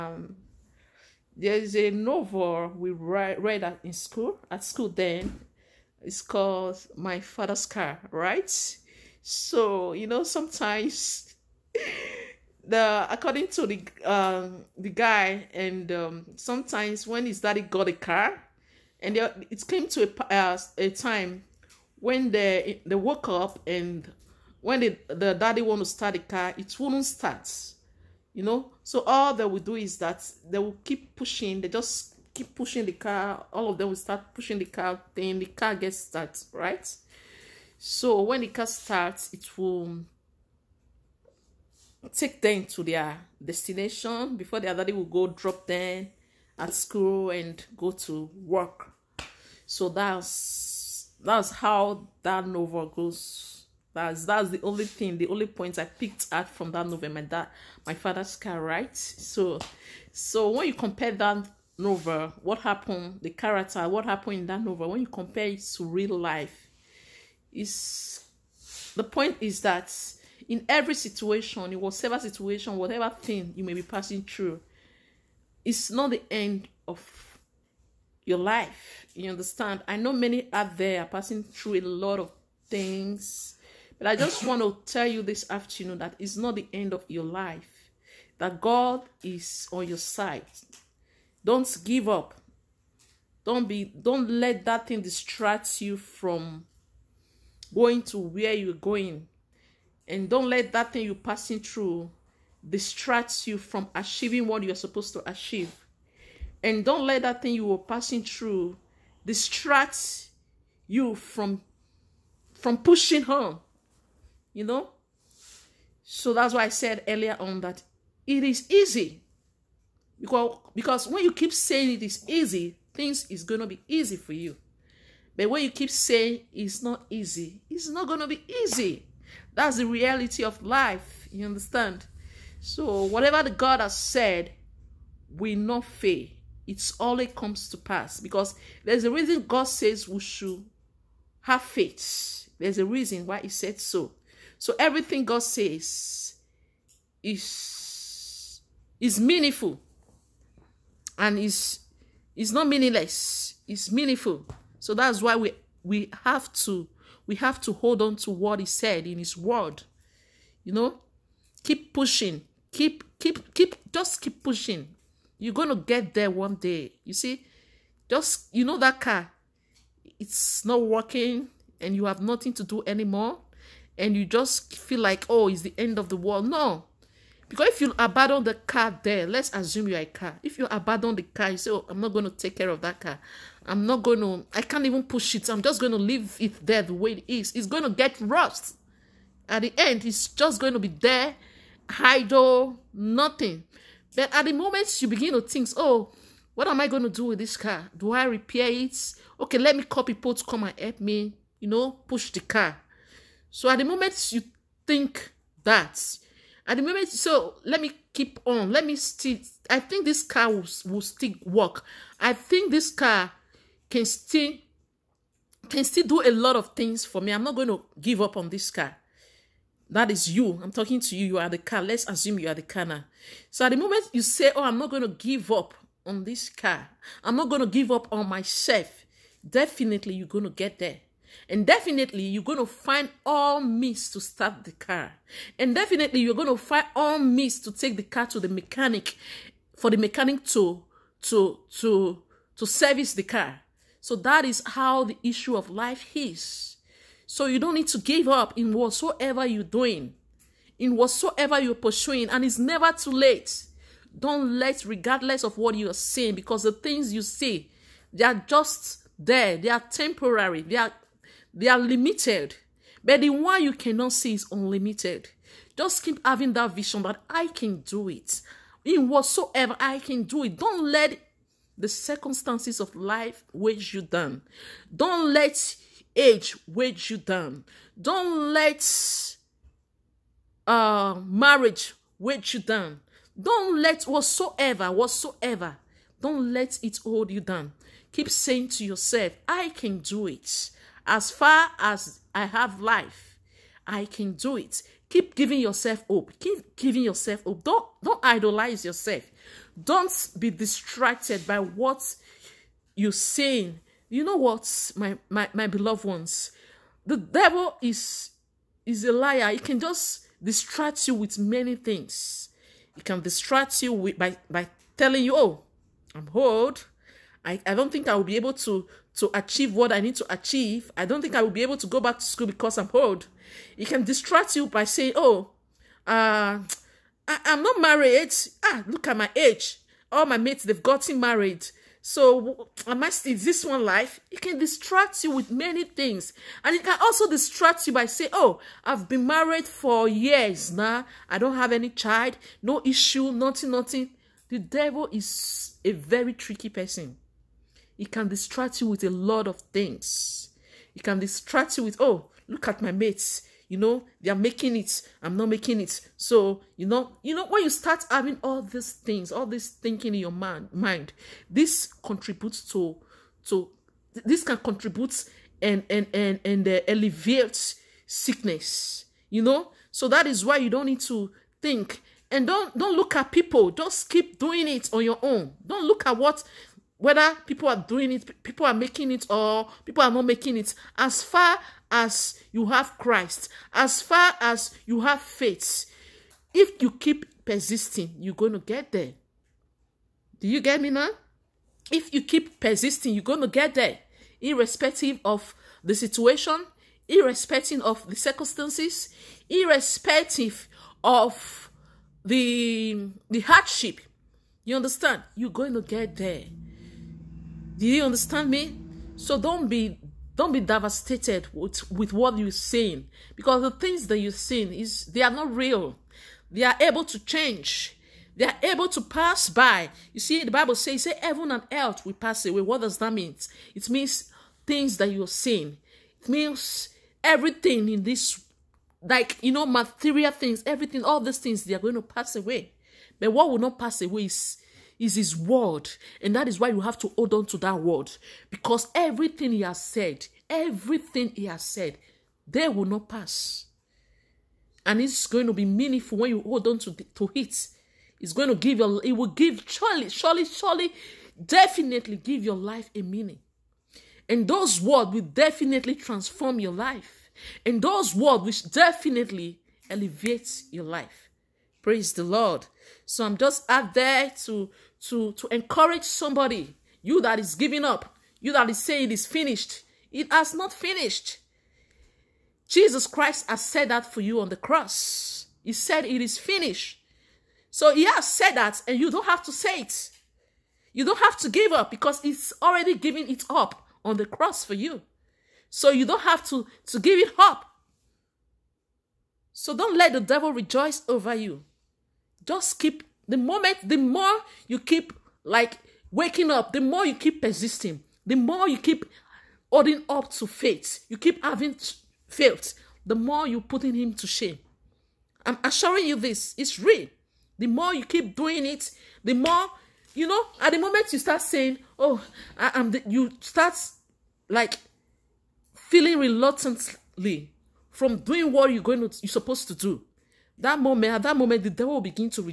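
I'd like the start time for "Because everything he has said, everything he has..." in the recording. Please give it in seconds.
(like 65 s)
438 s.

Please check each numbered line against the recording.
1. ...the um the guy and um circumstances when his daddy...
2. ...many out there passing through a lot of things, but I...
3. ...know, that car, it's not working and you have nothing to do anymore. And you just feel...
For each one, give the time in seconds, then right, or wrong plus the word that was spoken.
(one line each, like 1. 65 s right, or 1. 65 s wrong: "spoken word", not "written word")
1. 13 s wrong: "sometimes", not "circumstances"
2. 80 s right
3. 168 s right.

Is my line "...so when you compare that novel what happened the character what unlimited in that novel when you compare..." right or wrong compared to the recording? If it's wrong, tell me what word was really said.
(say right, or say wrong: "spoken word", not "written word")
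wrong: "happened", not "unlimited".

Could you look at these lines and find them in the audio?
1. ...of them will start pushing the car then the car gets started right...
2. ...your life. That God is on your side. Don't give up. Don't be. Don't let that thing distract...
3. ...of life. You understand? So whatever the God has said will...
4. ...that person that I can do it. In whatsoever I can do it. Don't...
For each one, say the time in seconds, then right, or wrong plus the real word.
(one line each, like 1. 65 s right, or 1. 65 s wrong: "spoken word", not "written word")
1. 33 s right
2. 87 s right
3. 130 s right
4. 266 s wrong: "vision", not "person".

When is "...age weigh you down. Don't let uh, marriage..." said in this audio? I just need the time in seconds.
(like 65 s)
276 s.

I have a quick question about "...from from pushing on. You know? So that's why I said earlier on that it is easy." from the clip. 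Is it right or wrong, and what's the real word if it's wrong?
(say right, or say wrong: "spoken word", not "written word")
right.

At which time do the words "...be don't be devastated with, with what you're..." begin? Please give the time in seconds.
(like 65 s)
409 s.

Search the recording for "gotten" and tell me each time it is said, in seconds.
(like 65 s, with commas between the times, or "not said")
330 s.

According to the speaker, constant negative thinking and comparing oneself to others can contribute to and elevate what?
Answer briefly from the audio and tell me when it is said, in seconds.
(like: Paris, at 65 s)
Sickness, at 368 s.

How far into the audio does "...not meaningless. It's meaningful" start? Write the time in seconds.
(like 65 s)
152 s.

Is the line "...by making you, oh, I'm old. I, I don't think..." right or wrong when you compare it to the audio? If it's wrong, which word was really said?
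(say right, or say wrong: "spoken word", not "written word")
wrong: "telling", not "making".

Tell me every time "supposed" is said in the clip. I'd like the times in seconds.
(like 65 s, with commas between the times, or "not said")
104 s, 519 s.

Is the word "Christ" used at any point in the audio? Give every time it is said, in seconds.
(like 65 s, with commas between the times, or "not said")
382 s, 473 s.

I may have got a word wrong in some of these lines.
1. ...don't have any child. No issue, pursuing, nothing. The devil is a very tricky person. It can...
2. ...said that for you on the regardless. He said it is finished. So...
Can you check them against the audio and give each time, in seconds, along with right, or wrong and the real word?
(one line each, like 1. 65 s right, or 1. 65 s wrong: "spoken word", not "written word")
1. 341 s wrong: "nothing", not "pursuing"
2. 473 s wrong: "cross", not "regardless".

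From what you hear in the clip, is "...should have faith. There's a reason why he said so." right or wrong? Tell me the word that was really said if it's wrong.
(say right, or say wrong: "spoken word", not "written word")
right.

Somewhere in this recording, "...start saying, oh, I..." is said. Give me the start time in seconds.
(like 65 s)
511 s.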